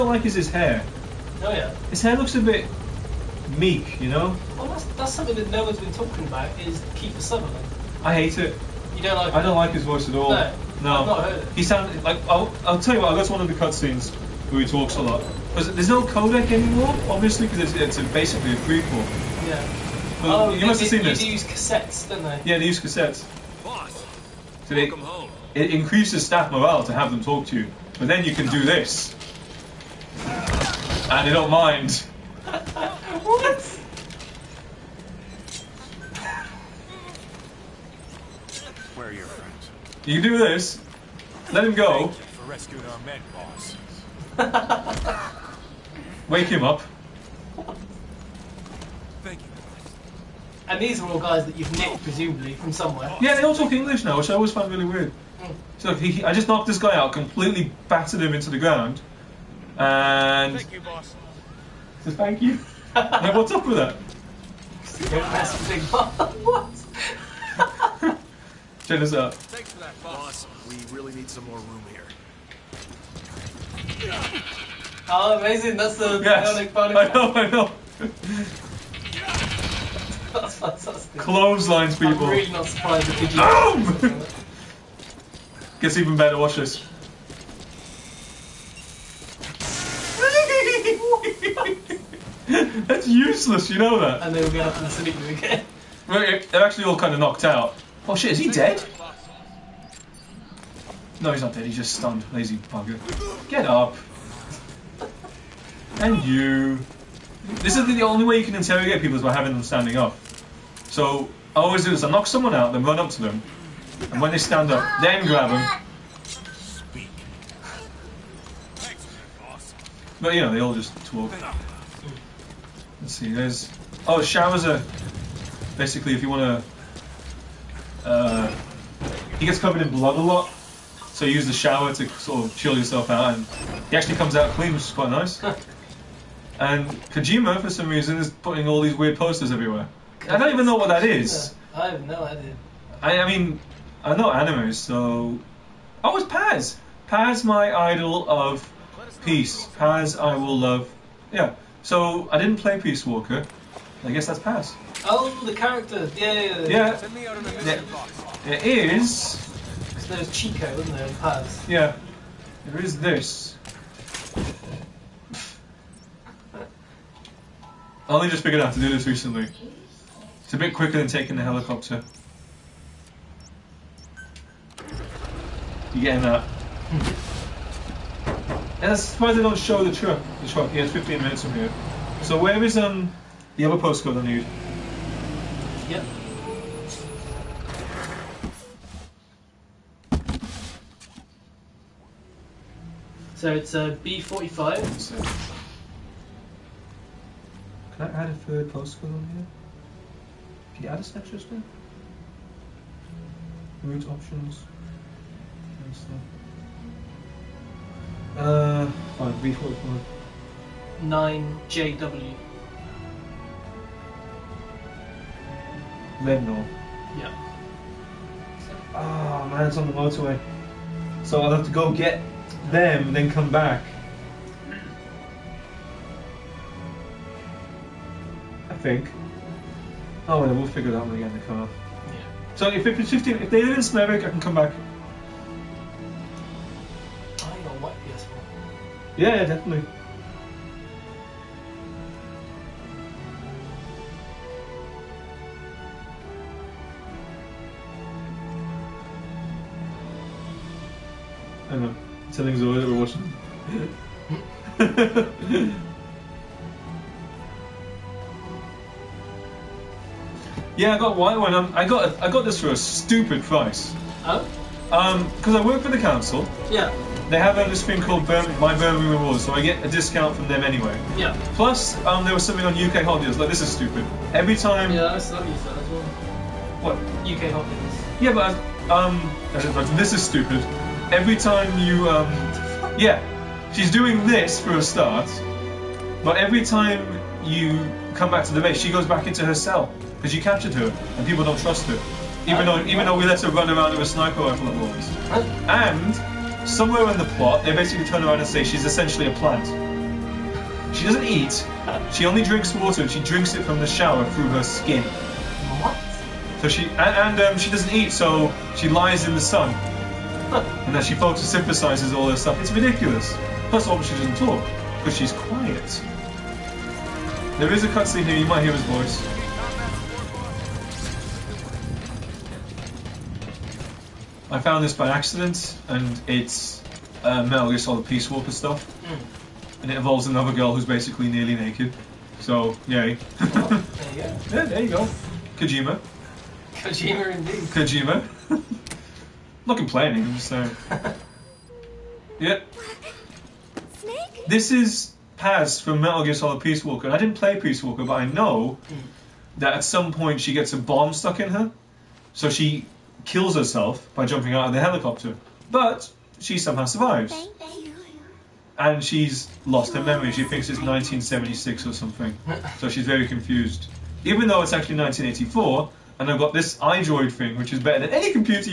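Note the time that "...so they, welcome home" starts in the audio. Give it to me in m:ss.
0:24.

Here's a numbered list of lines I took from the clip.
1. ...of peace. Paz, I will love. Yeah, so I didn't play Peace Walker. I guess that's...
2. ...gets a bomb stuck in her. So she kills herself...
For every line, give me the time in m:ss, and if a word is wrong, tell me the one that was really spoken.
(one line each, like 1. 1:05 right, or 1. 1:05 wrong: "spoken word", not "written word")
1. 2:28 right
2. 5:50 right.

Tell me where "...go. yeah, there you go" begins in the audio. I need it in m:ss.
5:33.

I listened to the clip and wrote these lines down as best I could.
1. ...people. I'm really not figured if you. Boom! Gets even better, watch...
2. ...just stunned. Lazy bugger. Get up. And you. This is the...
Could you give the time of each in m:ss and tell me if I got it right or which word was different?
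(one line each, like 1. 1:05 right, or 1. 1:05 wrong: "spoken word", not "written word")
1. 1:21 wrong: "surprised", not "figured"
2. 1:41 right.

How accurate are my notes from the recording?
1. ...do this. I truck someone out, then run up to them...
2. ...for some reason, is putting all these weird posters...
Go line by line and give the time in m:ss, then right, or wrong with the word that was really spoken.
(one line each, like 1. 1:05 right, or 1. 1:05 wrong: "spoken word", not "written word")
1. 1:51 wrong: "knock", not "truck"
2. 2:17 right.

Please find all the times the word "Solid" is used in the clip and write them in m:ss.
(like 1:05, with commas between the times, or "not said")
5:27, 5:46.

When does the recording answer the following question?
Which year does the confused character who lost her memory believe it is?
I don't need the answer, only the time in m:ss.
6:00.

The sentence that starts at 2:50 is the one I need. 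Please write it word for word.
It's a bit quicker than taking the helicopter.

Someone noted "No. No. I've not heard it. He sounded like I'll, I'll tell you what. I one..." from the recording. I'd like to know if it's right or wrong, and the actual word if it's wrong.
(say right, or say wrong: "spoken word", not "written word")
right.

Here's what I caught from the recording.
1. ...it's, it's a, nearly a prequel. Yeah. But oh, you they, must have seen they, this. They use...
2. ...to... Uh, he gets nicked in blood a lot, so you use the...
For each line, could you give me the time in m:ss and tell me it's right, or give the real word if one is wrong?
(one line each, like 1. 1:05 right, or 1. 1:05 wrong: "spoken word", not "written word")
1. 0:17 wrong: "basically", not "nearly"
2. 2:08 wrong: "covered", not "nicked".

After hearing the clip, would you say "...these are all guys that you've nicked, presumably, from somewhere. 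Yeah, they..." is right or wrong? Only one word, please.
right.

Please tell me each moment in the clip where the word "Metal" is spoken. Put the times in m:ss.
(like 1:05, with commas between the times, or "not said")
5:27, 5:46.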